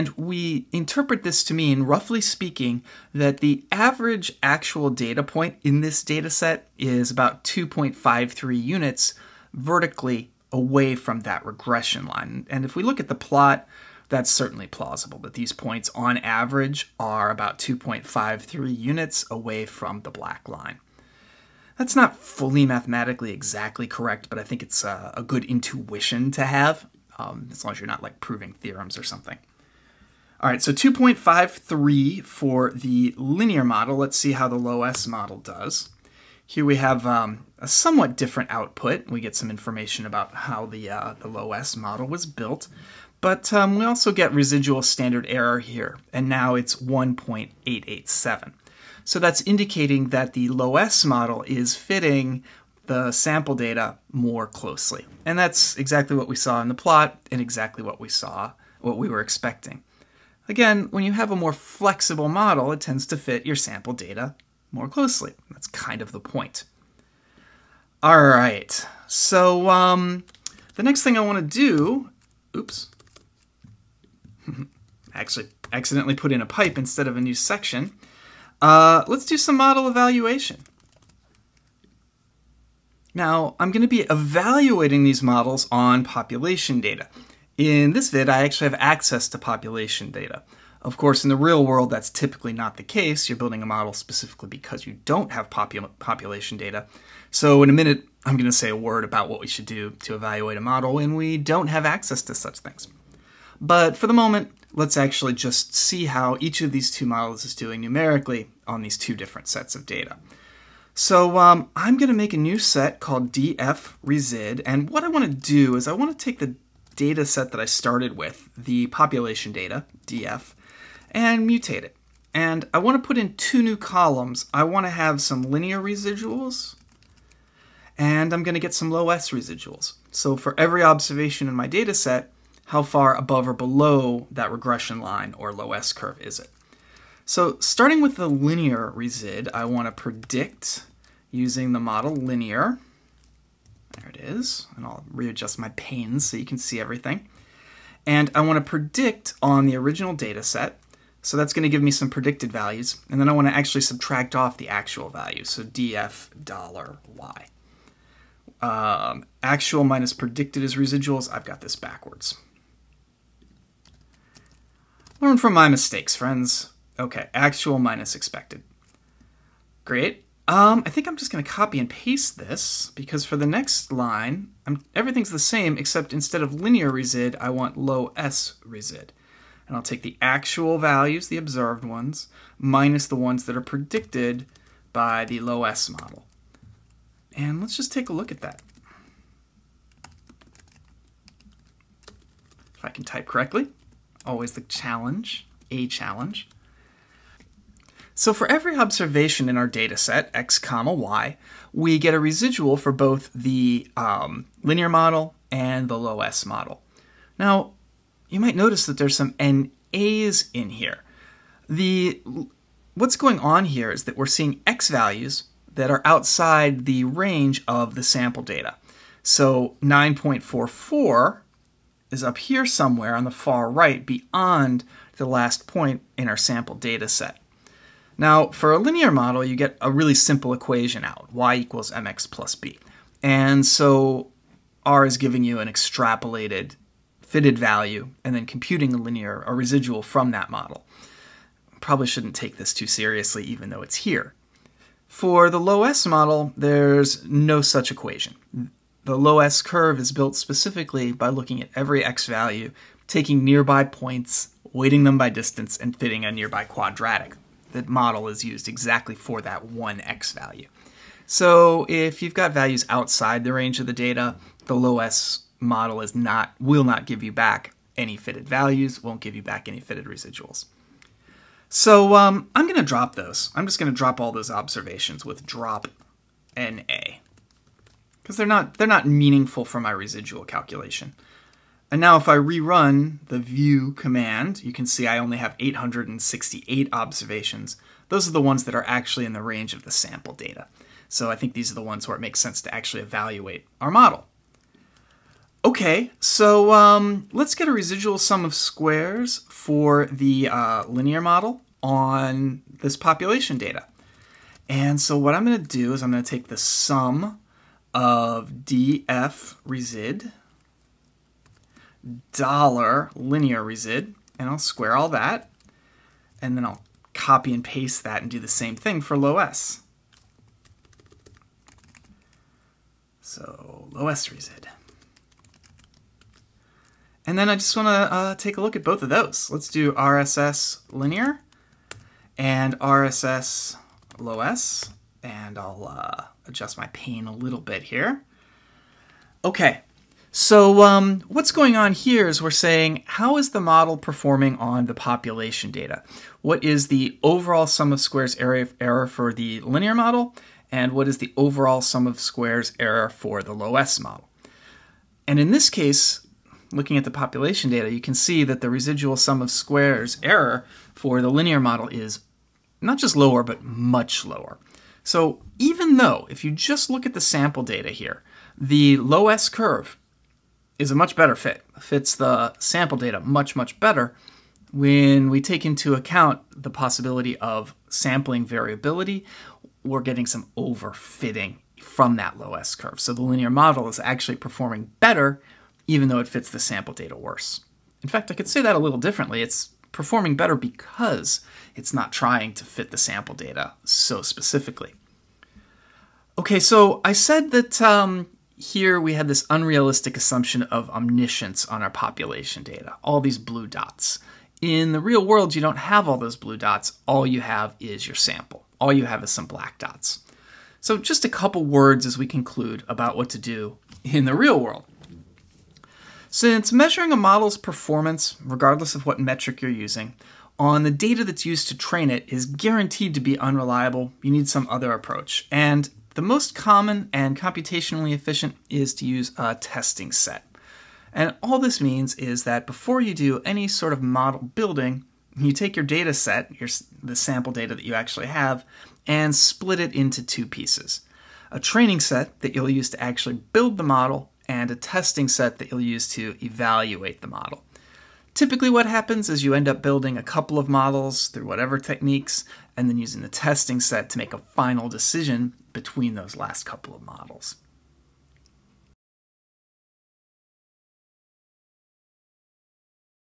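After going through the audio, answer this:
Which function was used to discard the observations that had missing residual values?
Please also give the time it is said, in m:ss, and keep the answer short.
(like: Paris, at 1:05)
drop NA, at 4:35.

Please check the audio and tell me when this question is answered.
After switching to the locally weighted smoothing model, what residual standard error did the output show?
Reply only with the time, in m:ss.
0:46.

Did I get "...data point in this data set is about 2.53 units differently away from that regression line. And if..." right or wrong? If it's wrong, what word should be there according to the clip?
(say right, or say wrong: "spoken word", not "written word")
wrong: "vertically", not "differently".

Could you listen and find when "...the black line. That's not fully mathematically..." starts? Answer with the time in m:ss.
0:20.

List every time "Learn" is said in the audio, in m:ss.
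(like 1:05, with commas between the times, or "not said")
2:45.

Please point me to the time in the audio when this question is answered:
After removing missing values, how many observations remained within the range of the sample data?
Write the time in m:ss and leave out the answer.
4:45.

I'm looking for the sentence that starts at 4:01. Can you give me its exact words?
Probably shouldn't take this too seriously, even though it's here.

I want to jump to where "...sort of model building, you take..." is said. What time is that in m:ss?
7:13.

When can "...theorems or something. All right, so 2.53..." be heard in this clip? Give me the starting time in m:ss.
0:28.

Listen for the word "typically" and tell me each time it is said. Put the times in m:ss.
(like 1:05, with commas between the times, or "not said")
1:32, 7:28.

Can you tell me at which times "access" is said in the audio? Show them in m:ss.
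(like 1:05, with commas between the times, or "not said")
1:28, 1:41.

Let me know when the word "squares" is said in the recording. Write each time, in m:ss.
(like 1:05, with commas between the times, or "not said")
4:58, 5:14, 5:47, 5:52, 5:59.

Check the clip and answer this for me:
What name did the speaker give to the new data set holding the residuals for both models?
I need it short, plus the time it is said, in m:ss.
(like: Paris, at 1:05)
df_resid, at 1:53.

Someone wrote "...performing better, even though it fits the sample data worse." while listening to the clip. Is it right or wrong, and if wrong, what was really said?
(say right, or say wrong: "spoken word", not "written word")
right.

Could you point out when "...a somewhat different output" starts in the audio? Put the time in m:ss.
0:37.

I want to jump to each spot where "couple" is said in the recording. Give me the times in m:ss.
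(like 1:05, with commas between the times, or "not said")
6:51, 7:30, 7:36.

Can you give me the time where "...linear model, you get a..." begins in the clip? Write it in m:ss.
3:48.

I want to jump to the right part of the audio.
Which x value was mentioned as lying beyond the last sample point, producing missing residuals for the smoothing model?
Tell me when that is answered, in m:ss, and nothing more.
3:39.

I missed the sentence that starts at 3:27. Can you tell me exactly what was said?
Now, you might notice that there's some NAs in here.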